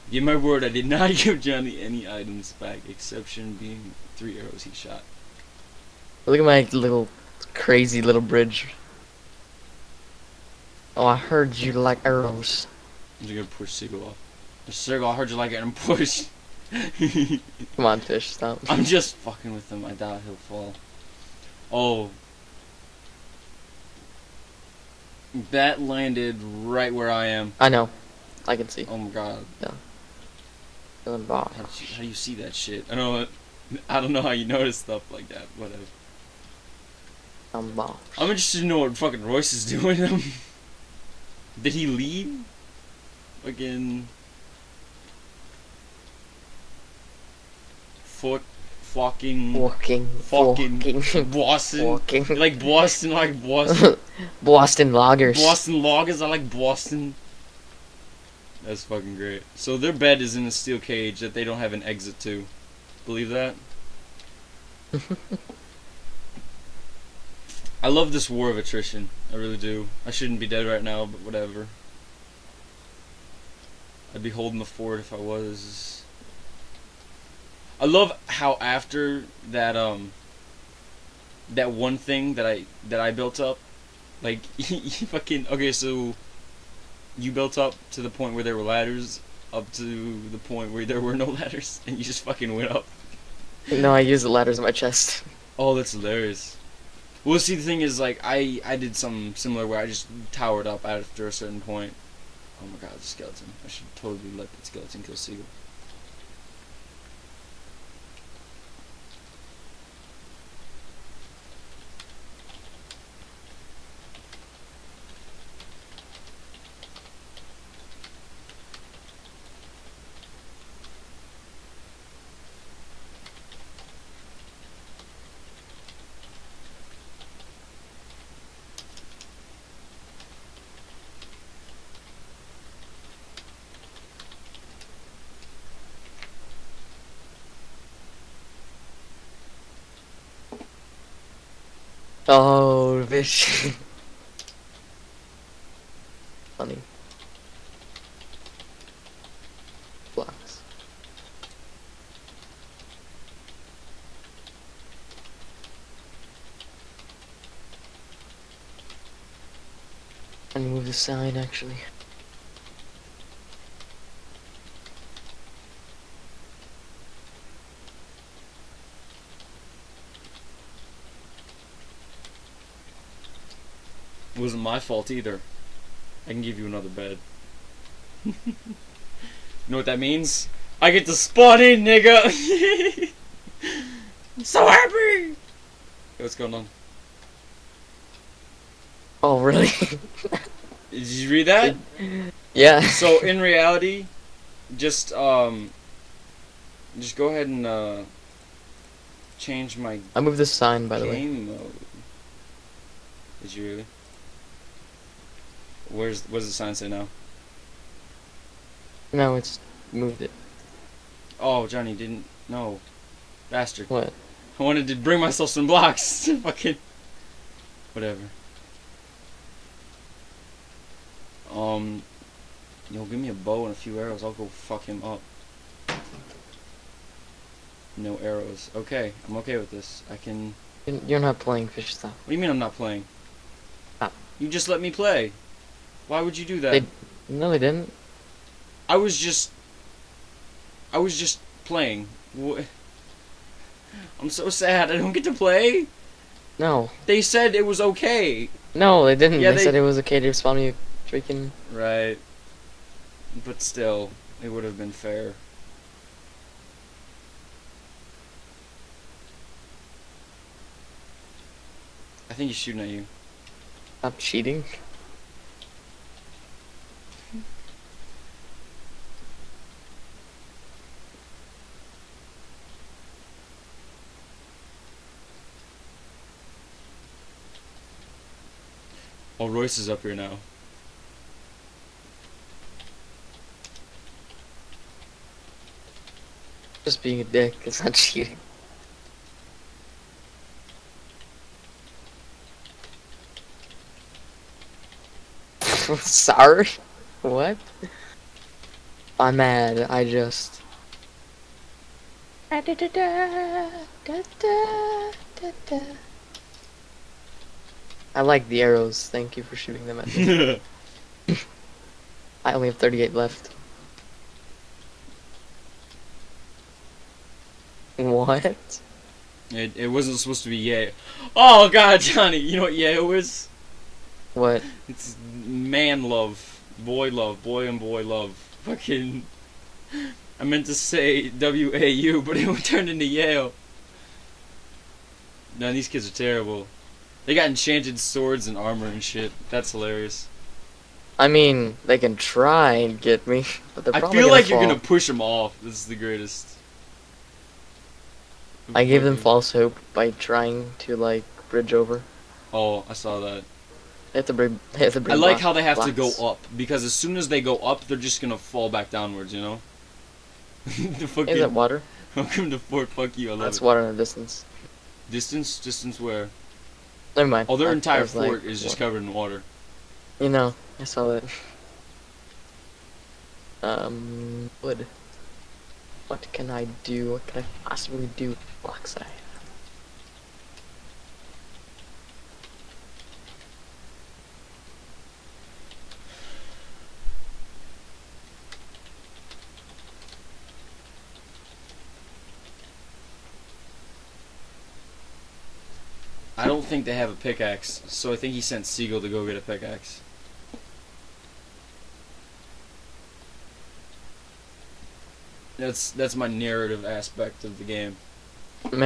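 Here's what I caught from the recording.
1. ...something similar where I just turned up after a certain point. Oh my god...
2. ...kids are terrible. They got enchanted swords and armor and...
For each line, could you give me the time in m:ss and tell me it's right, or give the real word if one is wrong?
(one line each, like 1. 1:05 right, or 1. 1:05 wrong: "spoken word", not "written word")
1. 1:38 wrong: "towered", not "turned"
2. 5:35 right.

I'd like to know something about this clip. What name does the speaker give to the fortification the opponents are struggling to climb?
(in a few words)
Fort Fuck You.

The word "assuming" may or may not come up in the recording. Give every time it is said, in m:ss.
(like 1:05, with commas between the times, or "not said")
not said.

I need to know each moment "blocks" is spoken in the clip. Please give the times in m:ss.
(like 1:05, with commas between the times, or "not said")
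2:30, 3:35, 5:55.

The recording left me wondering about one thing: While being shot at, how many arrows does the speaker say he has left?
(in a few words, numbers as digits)
38.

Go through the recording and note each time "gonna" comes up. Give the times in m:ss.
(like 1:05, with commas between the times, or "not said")
0:13, 5:44, 5:58.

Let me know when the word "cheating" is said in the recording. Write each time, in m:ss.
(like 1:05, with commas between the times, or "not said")
4:24, 4:47.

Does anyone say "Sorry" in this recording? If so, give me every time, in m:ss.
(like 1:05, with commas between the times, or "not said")
4:55.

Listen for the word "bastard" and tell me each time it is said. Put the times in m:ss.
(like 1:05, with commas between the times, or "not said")
3:33.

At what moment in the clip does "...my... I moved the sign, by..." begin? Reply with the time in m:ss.
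3:19.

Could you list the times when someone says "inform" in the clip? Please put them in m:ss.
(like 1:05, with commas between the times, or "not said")
not said.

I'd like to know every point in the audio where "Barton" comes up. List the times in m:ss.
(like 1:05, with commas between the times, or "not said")
not said.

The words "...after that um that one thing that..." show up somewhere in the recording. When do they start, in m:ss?
1:18.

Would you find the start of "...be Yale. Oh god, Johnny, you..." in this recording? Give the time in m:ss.
5:20.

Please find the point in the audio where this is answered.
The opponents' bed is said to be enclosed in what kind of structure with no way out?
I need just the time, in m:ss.
1:00.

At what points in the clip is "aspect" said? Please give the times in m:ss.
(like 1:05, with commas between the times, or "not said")
6:46.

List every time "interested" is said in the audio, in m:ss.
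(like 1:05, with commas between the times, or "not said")
0:38.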